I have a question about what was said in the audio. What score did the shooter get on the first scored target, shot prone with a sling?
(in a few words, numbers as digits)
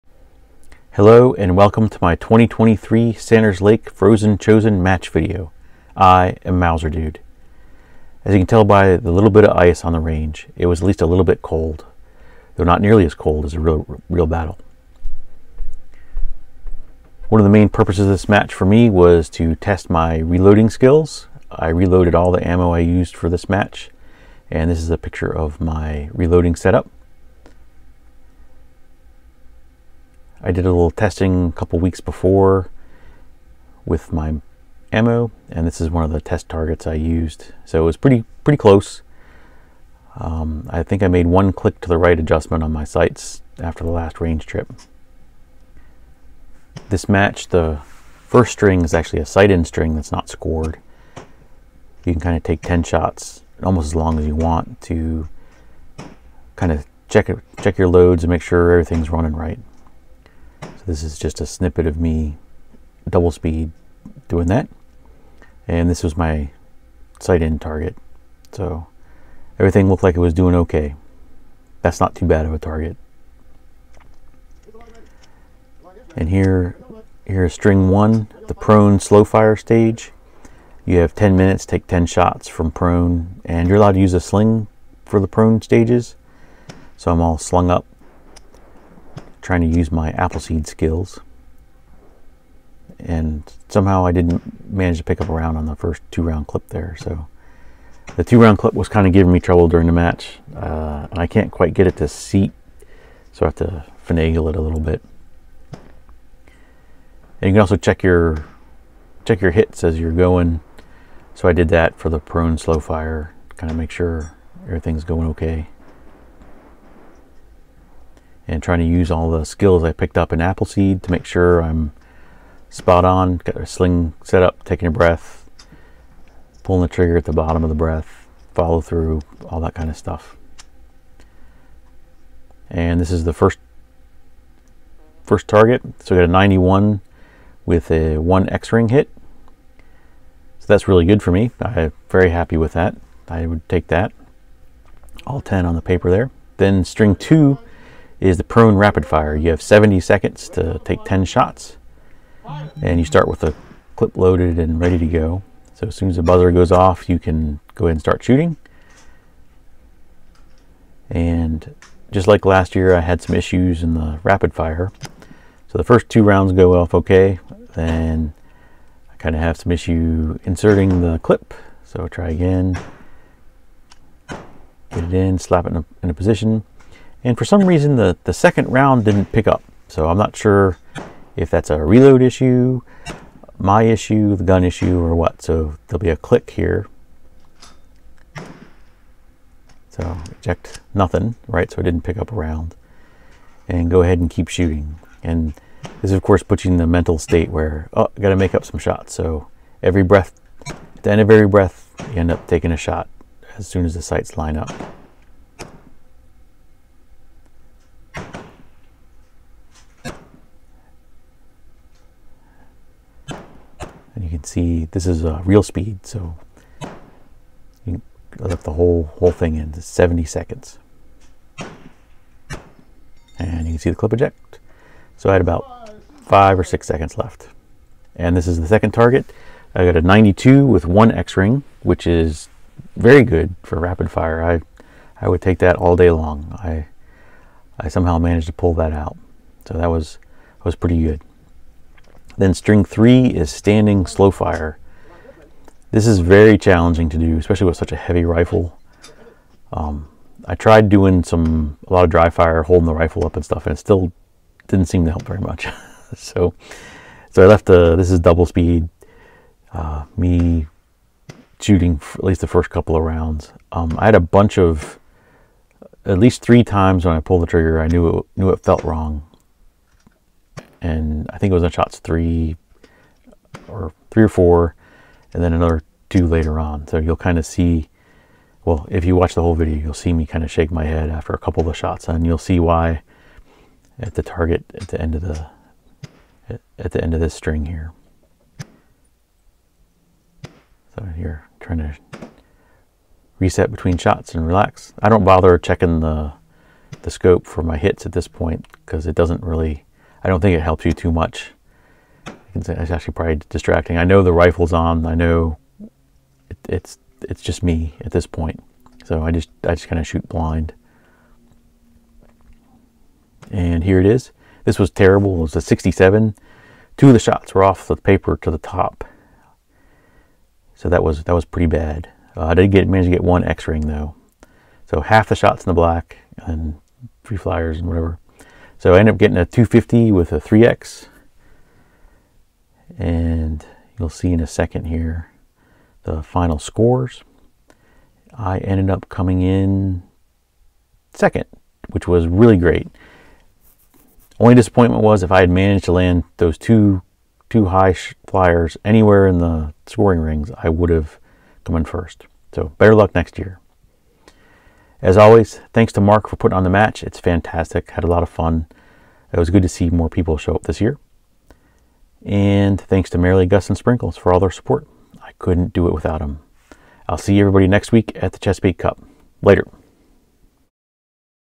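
91.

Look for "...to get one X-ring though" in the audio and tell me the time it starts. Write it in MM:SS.
05:23.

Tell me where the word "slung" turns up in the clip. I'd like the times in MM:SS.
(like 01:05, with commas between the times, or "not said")
01:27.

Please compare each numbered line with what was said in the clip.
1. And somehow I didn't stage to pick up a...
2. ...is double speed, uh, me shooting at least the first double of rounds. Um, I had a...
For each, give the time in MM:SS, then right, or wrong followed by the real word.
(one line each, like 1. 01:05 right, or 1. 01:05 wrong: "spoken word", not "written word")
1. 01:32 wrong: "manage", not "stage"
2. 04:18 wrong: "couple", not "double".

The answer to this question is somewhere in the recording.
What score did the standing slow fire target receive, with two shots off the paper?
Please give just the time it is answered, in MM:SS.
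05:15.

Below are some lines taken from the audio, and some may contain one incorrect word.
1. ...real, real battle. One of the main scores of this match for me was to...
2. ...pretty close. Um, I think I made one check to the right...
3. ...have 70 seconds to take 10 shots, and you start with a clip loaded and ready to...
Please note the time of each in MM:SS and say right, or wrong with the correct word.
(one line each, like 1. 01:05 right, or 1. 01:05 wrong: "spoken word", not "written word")
1. 00:13 wrong: "purposes", not "scores"
2. 00:38 wrong: "click", not "check"
3. 02:29 right.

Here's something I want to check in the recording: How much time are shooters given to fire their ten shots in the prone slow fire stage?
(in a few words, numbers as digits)
10 minutes.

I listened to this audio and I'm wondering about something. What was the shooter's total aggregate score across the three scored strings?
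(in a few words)
250.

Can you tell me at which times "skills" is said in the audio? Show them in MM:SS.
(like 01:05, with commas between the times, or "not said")
00:20, 01:30, 01:59.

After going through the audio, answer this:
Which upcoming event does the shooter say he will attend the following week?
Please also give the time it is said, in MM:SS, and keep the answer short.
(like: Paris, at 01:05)
Chesapeake Cup, at 06:08.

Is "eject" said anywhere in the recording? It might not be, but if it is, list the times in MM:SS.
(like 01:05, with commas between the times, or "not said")
03:10, 03:44.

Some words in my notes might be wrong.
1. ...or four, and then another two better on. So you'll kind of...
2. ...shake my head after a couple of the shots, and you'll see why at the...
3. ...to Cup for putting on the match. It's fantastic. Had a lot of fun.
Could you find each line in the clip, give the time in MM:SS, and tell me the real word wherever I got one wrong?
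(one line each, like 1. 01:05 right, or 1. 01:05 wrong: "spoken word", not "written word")
1. 04:34 wrong: "later", not "better"
2. 04:40 right
3. 05:55 wrong: "Mark", not "Cup".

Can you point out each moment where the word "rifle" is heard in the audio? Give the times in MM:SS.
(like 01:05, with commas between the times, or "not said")
04:08, 04:12, 05:04.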